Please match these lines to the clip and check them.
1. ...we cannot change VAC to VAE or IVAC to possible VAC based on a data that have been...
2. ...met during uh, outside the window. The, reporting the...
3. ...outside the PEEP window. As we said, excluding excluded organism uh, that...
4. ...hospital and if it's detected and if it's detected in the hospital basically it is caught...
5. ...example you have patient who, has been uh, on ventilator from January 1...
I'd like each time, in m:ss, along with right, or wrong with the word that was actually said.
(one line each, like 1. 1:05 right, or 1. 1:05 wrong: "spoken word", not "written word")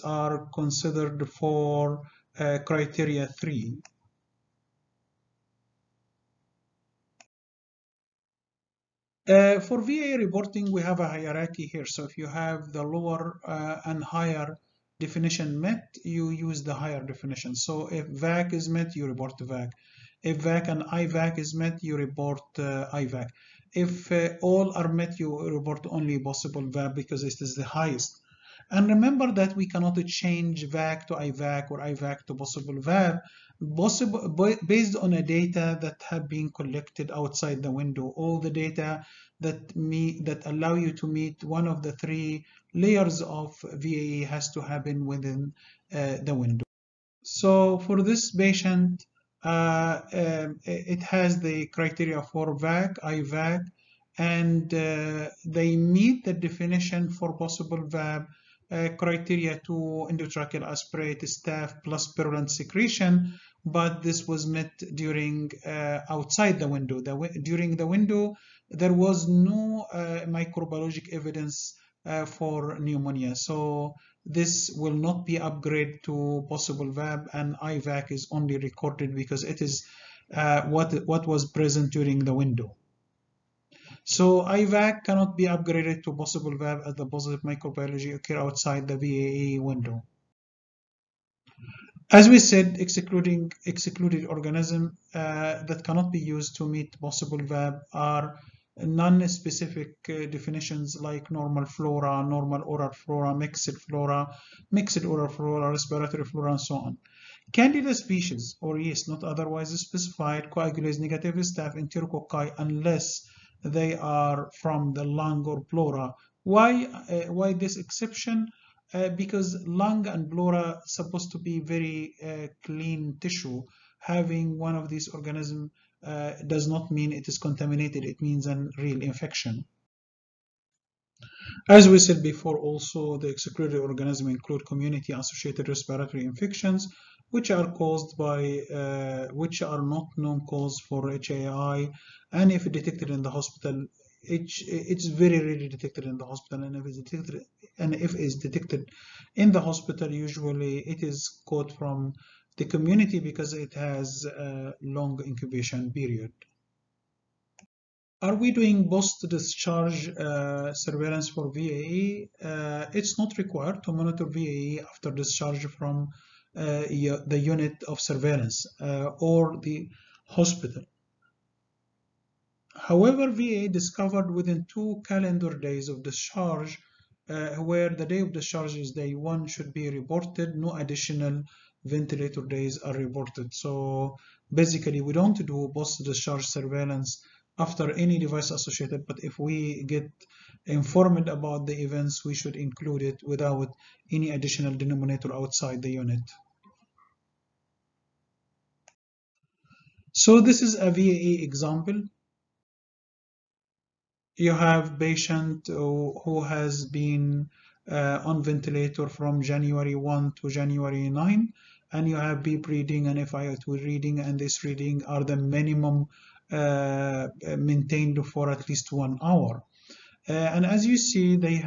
1. 0:29 wrong: "IVAC", not "VAE"
2. 1:04 wrong: "during", not "reporting"
3. 1:28 wrong: "VAE", not "PEEP"
4. 2:26 wrong: "usually", not "basically"
5. 3:21 right.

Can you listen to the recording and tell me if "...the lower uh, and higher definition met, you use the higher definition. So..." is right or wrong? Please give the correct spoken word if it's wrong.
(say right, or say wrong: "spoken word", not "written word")
right.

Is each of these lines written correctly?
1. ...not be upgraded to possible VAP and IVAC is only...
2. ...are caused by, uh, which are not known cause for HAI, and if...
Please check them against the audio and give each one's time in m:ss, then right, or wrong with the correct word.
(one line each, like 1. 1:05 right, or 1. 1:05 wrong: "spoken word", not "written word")
1. 1:14 right
2. 2:17 right.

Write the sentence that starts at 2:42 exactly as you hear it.
Uh, it's not required to monitor VAE after discharge from uh, the unit of surveillance uh, or the hospital.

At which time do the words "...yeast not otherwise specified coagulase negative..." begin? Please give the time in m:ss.
1:48.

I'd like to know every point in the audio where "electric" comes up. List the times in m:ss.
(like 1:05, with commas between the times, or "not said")
not said.